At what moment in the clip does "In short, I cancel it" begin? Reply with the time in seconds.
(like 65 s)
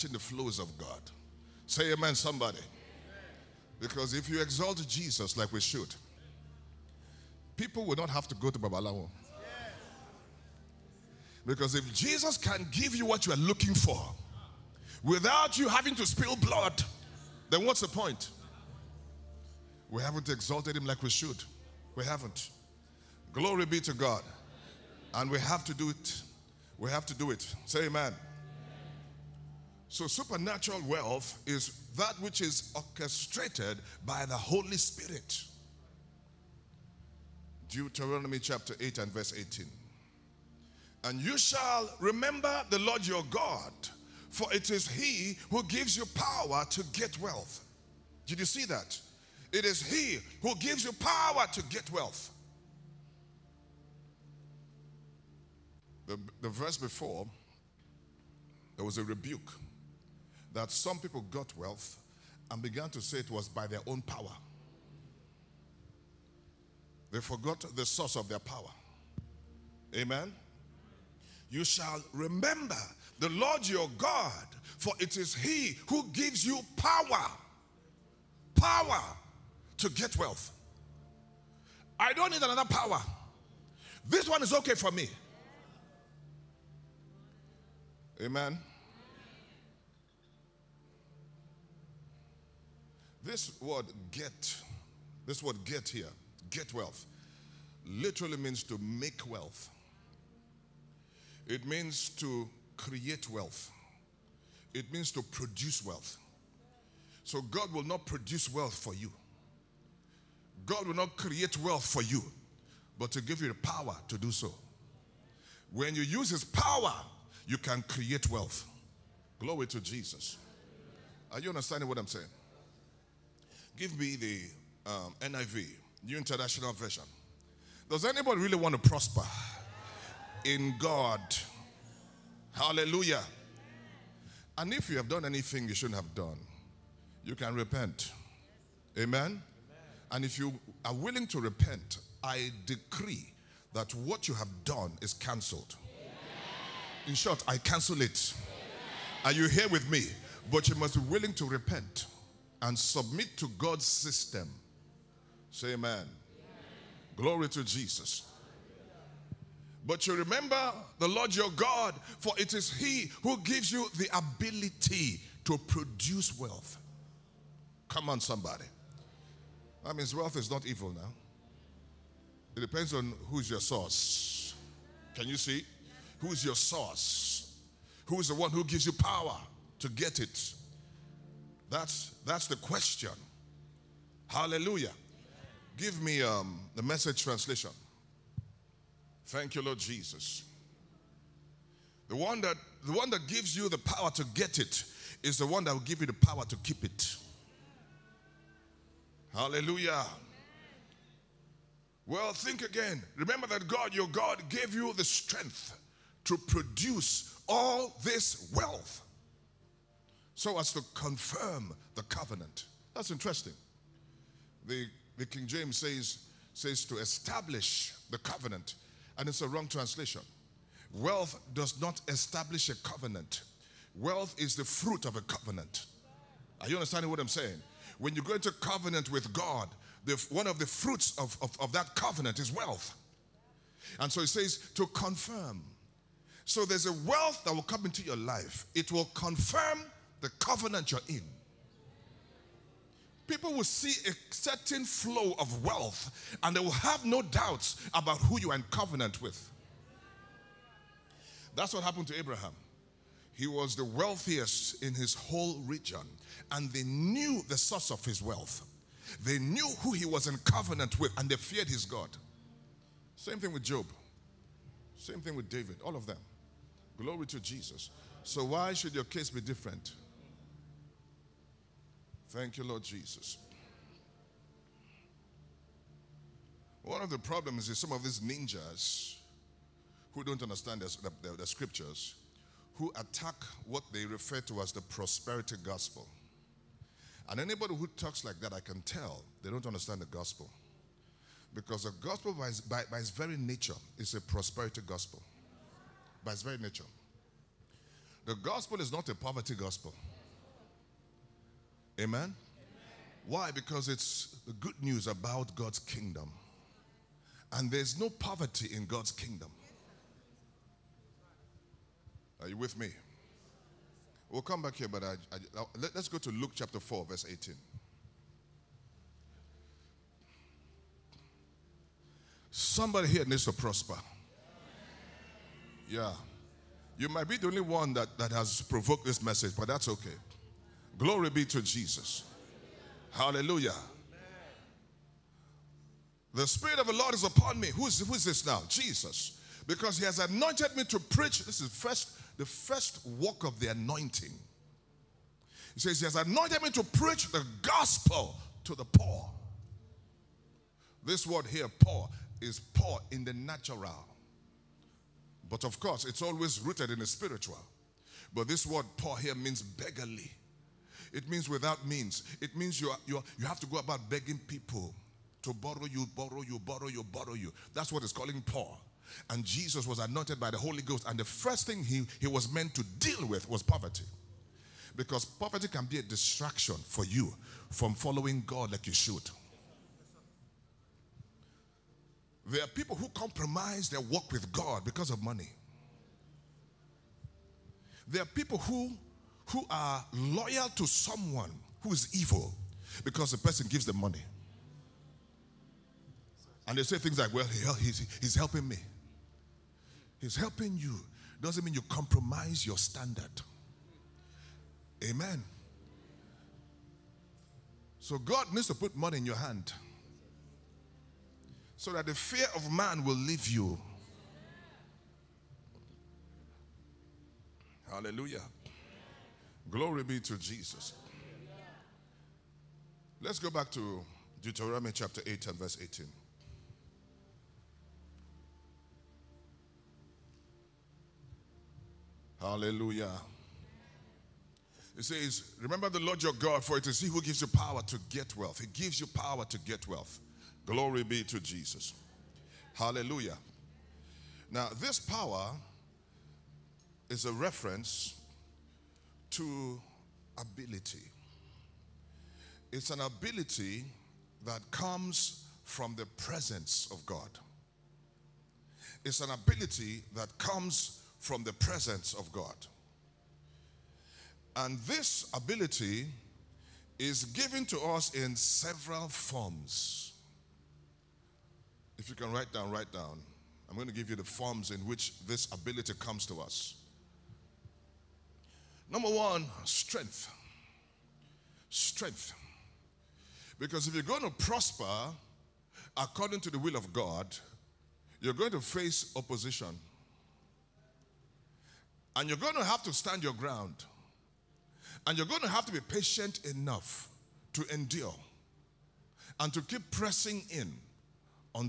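147 s.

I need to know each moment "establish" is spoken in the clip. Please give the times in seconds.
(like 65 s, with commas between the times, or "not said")
216 s, 222 s.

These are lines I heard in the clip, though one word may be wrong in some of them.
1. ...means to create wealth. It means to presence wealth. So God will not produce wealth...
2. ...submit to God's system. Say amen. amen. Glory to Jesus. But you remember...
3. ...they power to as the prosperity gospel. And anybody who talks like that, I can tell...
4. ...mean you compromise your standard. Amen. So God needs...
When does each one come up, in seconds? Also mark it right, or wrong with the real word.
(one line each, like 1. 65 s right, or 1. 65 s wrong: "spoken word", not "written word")
1. 101 s wrong: "produce", not "presence"
2. 152 s right
3. 283 s wrong: "refer", not "power"
4. 401 s right.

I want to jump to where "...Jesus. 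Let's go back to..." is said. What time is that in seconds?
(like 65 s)
420 s.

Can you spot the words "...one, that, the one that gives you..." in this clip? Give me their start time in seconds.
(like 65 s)
192 s.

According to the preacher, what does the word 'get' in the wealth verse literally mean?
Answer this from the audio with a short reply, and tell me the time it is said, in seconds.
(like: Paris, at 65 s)
To make wealth, at 98 s.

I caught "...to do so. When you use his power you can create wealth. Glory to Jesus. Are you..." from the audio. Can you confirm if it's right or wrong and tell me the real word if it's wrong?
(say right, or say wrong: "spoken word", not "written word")
right.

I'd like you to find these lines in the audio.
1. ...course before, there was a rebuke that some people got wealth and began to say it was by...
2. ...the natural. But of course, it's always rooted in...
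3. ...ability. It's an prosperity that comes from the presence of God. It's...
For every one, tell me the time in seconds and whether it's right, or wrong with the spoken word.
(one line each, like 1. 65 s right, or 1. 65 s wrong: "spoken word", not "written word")
1. 56 s wrong: "verse", not "course"
2. 353 s right
3. 450 s wrong: "ability", not "prosperity".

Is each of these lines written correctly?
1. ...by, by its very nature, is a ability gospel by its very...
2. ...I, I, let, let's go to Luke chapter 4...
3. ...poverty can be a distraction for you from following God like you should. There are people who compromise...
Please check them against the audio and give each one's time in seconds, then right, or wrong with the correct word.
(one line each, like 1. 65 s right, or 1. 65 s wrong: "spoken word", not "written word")
1. 292 s wrong: "prosperity", not "ability"
2. 315 s right
3. 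375 s right.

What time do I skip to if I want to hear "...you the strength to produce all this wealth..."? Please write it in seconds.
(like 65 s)
204 s.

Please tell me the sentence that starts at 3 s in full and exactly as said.
Because if you exalt Jesus like we should, people will not have to go to Babalawo.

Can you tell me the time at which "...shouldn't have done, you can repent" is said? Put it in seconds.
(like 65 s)
135 s.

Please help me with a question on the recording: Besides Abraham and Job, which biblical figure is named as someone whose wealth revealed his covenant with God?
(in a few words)
David.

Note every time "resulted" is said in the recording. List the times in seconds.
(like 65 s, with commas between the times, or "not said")
not said.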